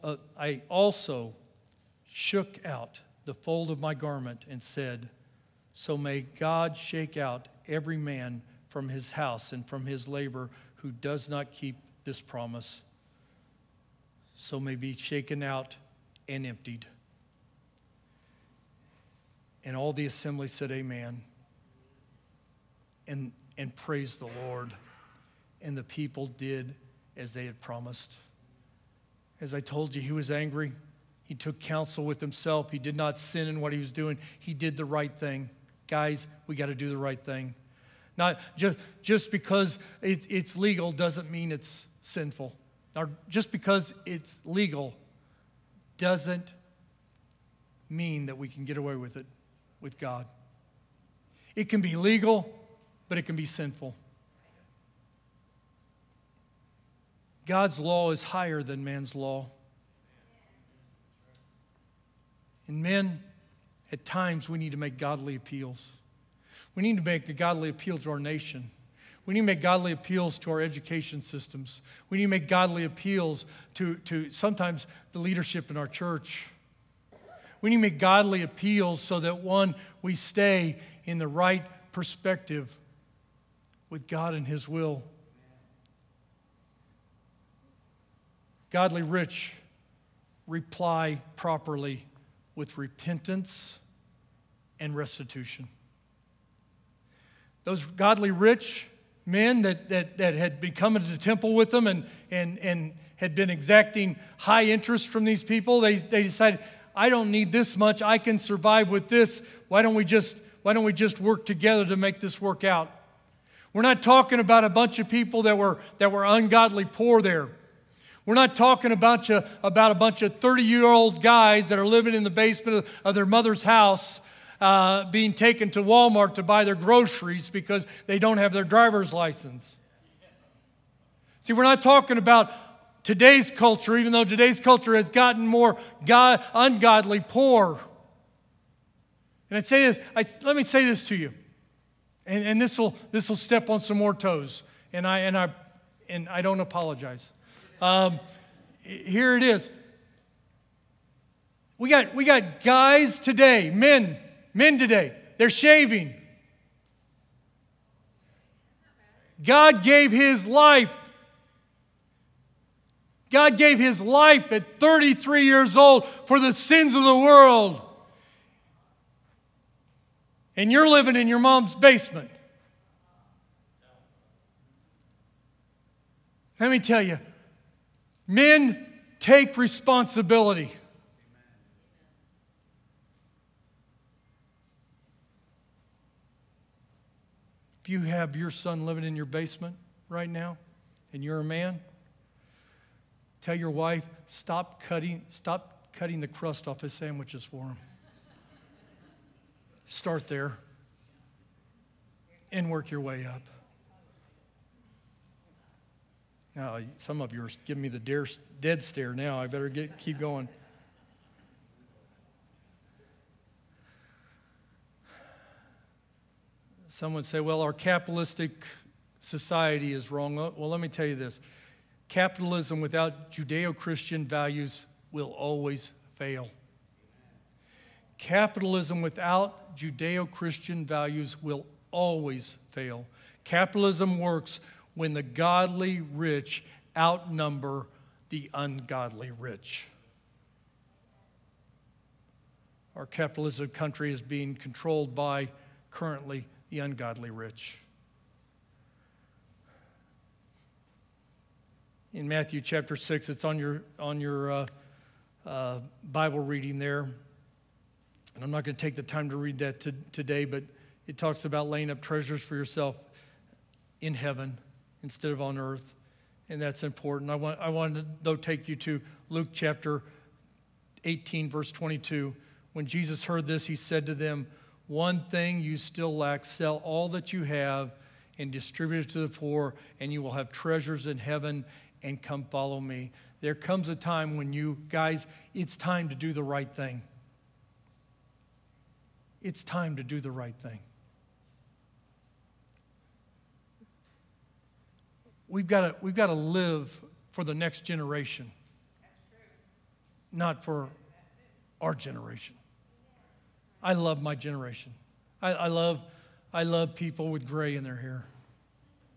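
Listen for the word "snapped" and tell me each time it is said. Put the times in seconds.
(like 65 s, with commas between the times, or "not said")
not said.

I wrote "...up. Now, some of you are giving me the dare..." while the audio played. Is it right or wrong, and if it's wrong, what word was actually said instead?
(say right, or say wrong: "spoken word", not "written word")
right.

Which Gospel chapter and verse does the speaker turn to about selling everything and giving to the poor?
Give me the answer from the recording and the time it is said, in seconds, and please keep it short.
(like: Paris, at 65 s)
Luke 18:22, at 269 s.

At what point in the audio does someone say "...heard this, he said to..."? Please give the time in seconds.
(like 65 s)
273 s.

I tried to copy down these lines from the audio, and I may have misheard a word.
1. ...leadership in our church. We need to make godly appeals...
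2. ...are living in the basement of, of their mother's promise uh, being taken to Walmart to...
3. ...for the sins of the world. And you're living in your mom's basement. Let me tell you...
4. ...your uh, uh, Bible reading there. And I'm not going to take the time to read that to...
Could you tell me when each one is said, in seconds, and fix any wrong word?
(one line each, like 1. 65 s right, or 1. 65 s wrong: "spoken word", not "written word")
1. 75 s right
2. 121 s wrong: "house", not "promise"
3. 166 s right
4. 254 s right.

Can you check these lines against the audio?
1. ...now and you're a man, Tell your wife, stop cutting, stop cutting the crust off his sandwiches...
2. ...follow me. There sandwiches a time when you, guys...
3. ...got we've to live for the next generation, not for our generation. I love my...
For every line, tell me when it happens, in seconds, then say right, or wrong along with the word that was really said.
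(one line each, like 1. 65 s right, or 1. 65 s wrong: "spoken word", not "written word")
1. 190 s right
2. 282 s wrong: "comes", not "sandwiches"
3. 295 s right.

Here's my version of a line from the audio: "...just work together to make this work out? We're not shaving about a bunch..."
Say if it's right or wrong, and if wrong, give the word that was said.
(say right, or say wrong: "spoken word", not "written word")
wrong: "talking", not "shaving".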